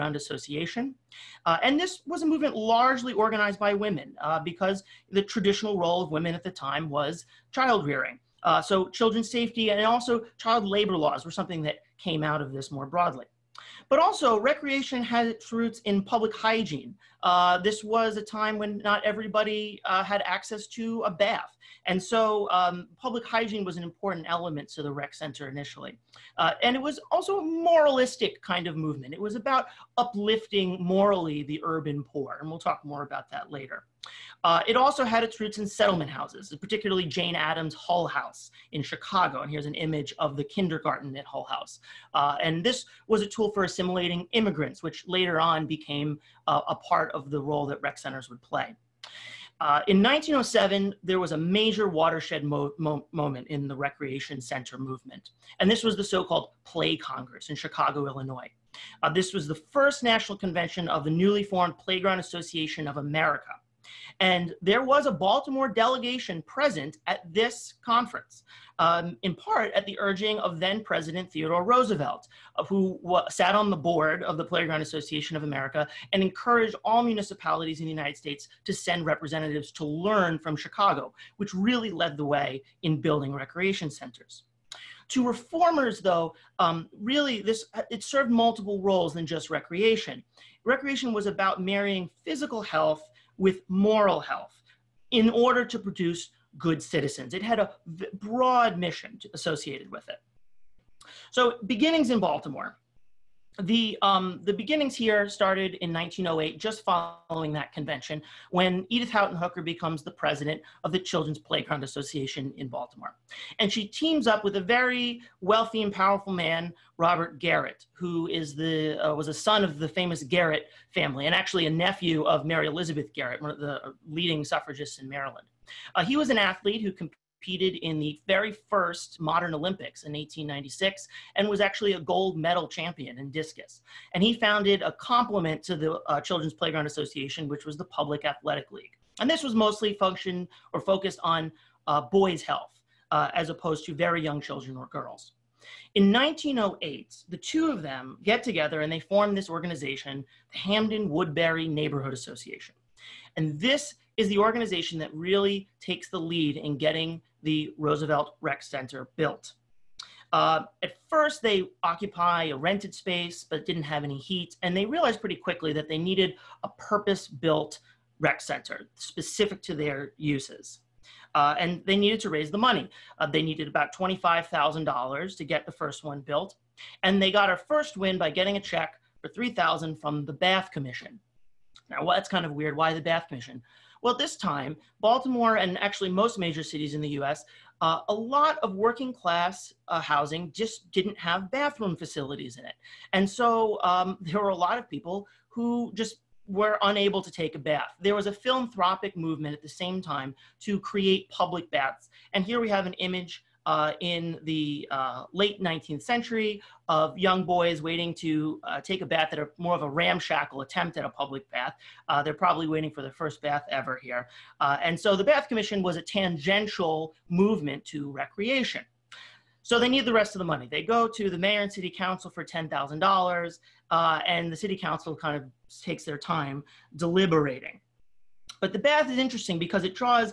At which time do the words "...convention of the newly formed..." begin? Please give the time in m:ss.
1:00.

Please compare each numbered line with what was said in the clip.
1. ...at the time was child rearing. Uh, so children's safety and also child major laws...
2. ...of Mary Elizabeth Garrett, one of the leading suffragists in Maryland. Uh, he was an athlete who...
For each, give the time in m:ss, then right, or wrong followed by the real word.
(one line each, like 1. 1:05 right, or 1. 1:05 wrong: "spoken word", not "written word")
1. 0:06 wrong: "labor", not "major"
2. 2:02 right.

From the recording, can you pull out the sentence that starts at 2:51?
Uh, and they needed to raise the money.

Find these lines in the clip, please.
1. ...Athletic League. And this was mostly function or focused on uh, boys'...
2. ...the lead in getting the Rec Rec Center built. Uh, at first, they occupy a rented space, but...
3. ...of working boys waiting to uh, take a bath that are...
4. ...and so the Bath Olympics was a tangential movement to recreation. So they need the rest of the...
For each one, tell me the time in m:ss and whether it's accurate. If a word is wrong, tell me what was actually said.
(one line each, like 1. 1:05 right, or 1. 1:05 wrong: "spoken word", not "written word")
1. 2:18 right
2. 2:36 wrong: "Roosevelt", not "Rec"
3. 3:26 wrong: "young", not "working"
4. 3:34 wrong: "Commission", not "Olympics".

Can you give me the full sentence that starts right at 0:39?
And here's an image of the kindergarten at Hull House.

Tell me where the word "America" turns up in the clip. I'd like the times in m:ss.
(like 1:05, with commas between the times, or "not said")
1:02, 1:15.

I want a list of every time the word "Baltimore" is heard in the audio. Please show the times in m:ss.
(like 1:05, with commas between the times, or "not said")
1:05, 1:42, 1:52, 3:04.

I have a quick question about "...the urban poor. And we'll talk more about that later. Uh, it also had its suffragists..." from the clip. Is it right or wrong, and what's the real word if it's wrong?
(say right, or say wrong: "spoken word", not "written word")
wrong: "roots", not "suffragists".